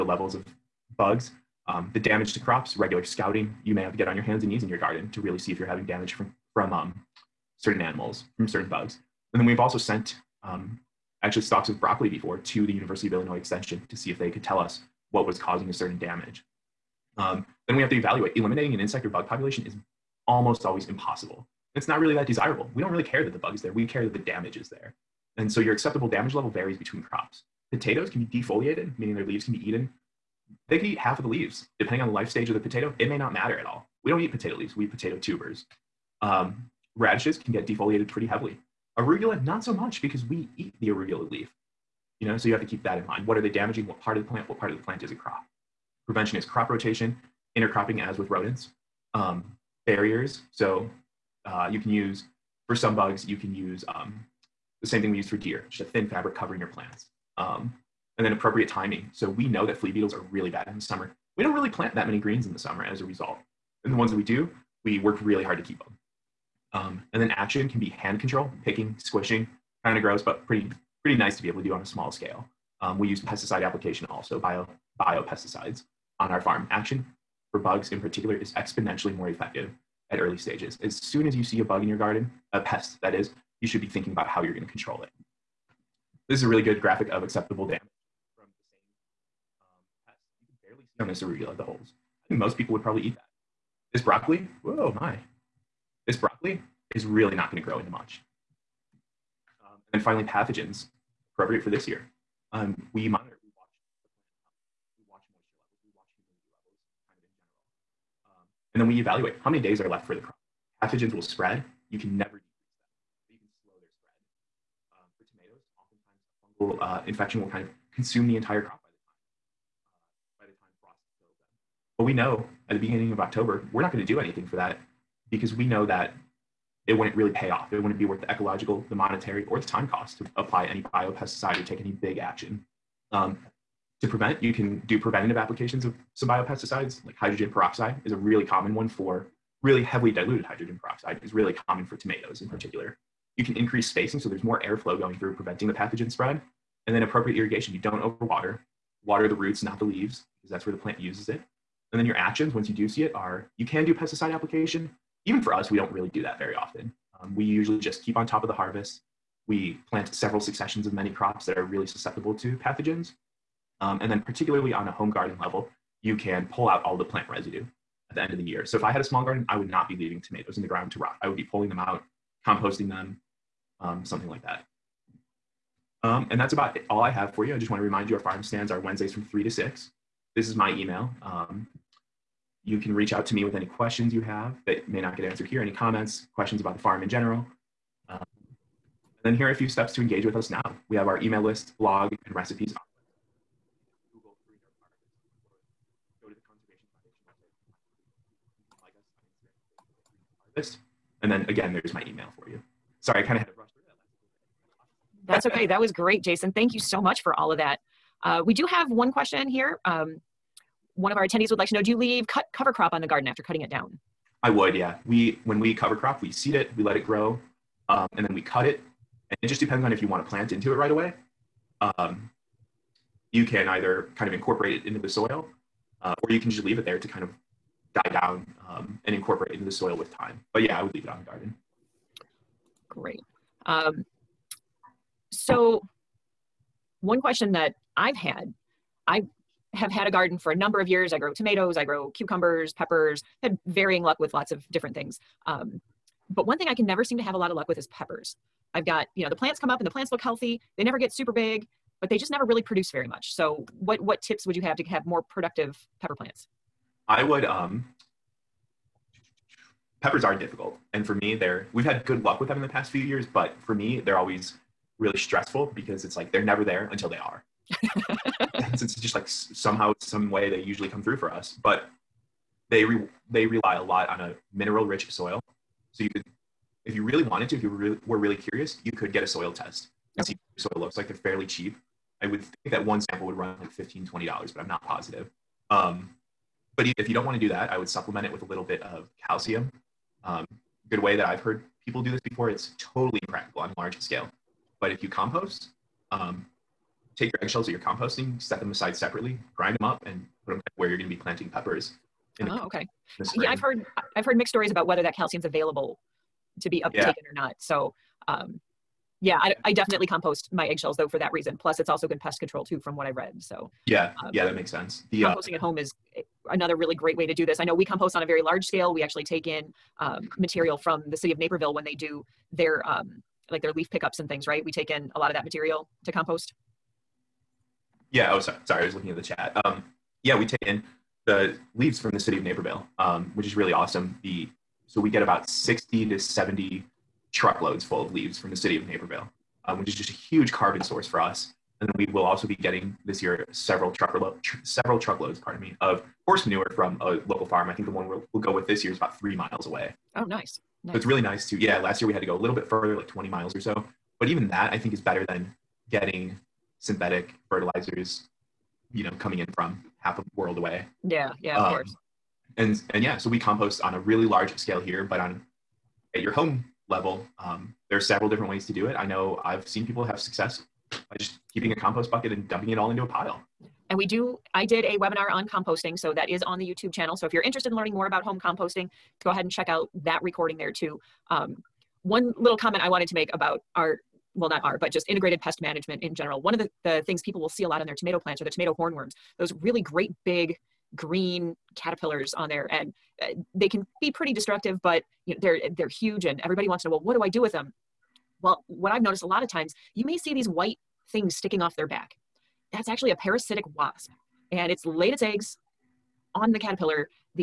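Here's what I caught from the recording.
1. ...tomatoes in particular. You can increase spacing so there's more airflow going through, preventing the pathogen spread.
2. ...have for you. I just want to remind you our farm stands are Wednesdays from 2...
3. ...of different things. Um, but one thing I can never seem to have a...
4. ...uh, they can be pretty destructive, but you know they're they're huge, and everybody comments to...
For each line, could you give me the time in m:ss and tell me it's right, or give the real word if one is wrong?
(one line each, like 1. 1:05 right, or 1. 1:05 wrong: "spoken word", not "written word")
1. 2:21 right
2. 2:57 wrong: "3", not "2"
3. 4:04 right
4. 6:33 wrong: "wants", not "comments".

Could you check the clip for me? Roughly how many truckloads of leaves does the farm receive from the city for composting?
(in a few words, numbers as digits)
60 to 70.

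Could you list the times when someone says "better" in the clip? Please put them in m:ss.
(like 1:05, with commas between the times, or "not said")
5:54.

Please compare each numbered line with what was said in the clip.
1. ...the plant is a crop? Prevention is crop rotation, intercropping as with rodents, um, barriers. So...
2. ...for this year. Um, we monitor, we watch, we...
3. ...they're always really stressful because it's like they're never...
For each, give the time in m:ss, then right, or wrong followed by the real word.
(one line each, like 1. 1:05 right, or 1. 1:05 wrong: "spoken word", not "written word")
1. 0:44 right
2. 1:41 right
3. 4:23 right.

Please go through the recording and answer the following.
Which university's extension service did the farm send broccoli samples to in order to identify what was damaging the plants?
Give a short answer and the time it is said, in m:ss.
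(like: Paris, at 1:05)
University of Illinois, at 0:12.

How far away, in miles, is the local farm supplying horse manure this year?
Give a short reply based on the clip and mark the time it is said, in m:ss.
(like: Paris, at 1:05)
3 miles, at 5:49.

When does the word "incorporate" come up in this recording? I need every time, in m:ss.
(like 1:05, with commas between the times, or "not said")
3:44, 3:49.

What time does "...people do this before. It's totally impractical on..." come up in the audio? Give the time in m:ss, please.
4:51.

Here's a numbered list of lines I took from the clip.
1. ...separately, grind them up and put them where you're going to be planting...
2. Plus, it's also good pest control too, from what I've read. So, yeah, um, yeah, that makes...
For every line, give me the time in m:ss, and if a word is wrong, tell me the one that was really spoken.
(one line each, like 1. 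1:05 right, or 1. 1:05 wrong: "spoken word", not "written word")
1. 4:58 right
2. 5:11 right.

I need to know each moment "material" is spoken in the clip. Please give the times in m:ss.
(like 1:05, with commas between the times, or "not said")
5:20, 5:25.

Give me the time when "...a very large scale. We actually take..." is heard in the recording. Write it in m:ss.
5:18.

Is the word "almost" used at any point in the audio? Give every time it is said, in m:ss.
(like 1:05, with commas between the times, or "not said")
0:20.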